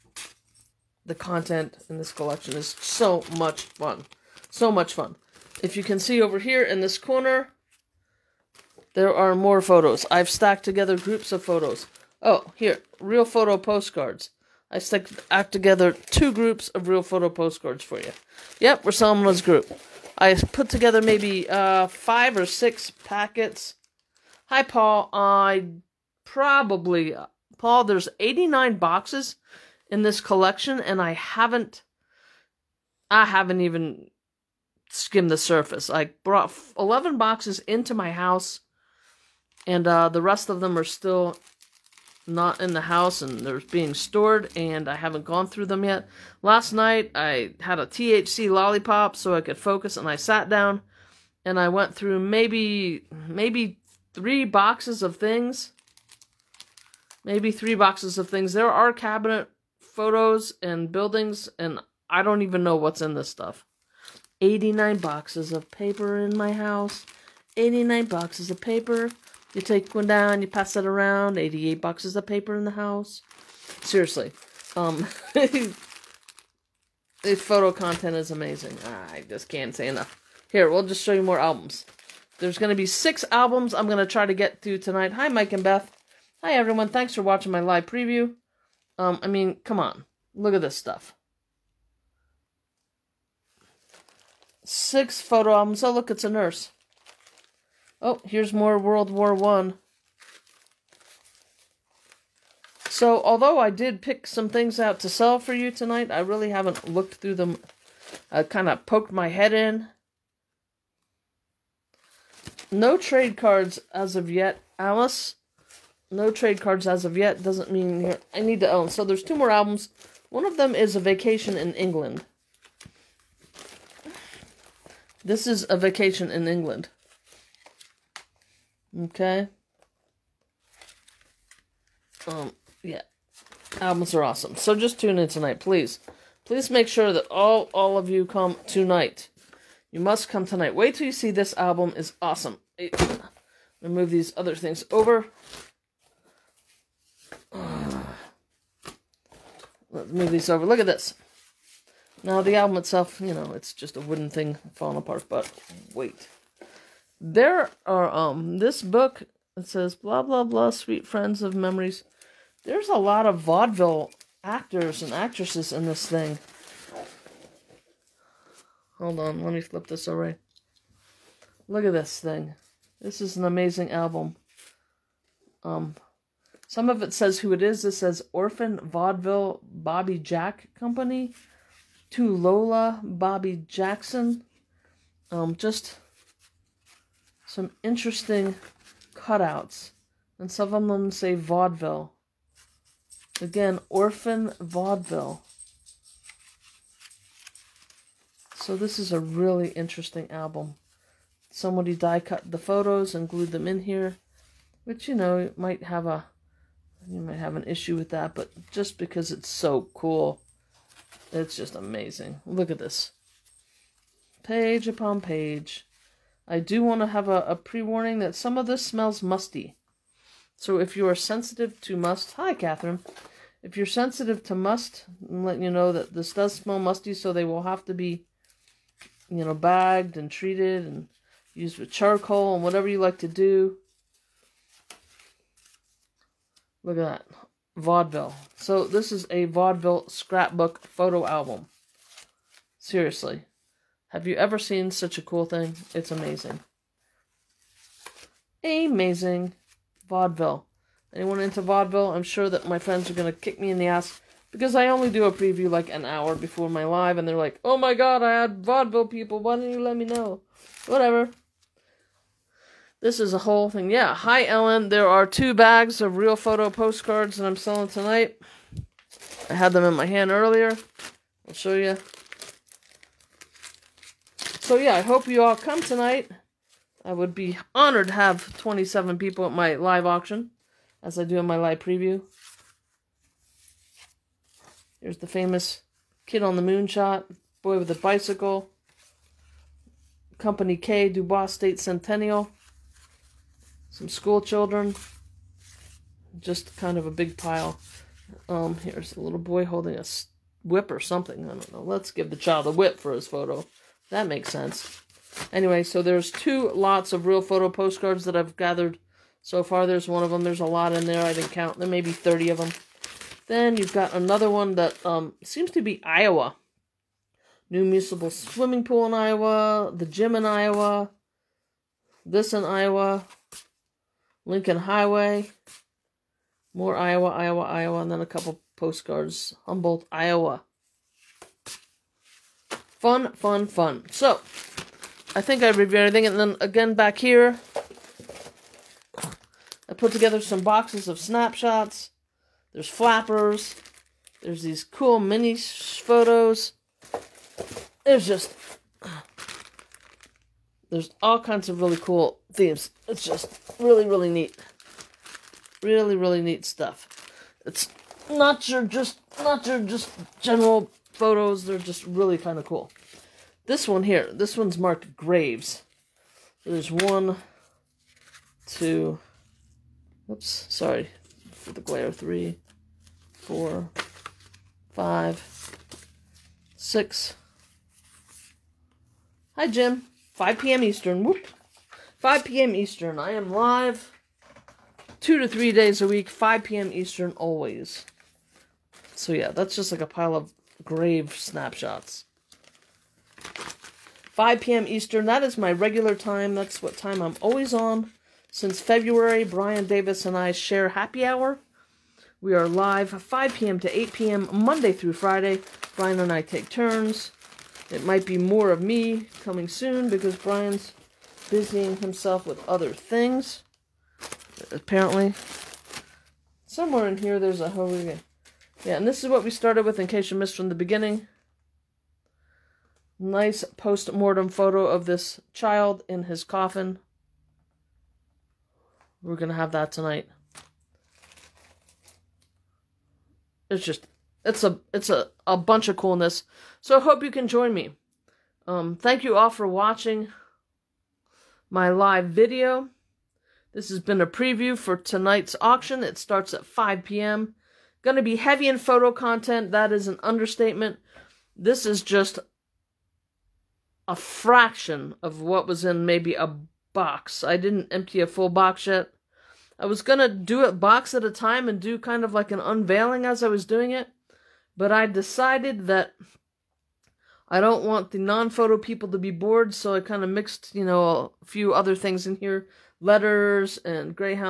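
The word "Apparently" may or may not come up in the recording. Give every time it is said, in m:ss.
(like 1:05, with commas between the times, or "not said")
6:54.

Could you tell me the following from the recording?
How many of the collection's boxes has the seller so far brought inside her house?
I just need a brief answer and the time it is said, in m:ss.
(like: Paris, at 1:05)
11, at 0:36.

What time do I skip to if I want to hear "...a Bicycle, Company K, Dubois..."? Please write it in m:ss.
4:47.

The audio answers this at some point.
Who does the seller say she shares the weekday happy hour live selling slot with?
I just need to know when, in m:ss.
6:39.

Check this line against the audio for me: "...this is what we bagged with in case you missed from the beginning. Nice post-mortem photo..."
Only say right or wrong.
wrong.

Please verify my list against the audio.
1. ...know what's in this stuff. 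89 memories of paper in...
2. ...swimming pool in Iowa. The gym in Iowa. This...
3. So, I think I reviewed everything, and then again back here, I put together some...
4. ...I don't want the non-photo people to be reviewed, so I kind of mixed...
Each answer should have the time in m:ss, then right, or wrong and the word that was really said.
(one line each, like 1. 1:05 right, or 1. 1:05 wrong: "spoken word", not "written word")
1. 1:02 wrong: "boxes", not "memories"
2. 5:18 right
3. 5:34 right
4. 7:47 wrong: "bored", not "reviewed".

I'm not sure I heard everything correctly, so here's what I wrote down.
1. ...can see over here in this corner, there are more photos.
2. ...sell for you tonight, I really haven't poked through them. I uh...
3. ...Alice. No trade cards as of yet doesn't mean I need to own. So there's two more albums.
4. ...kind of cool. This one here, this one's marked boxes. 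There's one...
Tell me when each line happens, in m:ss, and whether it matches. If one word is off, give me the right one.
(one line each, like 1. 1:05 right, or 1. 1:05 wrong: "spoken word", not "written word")
1. 0:05 right
2. 1:45 wrong: "looked", not "poked"
3. 1:54 right
4. 6:02 wrong: "graves", not "boxes".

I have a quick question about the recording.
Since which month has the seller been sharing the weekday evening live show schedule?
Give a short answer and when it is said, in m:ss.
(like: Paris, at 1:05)
February, at 6:38.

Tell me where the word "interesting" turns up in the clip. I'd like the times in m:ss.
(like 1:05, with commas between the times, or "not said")
3:07, 3:19.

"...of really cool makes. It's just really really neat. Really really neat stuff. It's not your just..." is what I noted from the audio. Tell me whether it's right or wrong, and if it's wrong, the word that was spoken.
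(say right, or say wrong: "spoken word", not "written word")
wrong: "themes", not "makes".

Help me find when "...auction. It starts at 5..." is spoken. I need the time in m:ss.
7:25.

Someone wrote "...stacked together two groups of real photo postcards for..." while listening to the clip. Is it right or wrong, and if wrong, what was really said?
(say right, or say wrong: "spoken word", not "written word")
right.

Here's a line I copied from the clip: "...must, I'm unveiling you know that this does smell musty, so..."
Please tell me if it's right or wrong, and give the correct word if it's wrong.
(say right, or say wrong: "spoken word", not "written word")
wrong: "letting", not "unveiling".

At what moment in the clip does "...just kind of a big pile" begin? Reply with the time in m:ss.
4:56.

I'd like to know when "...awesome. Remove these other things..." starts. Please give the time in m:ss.
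2:22.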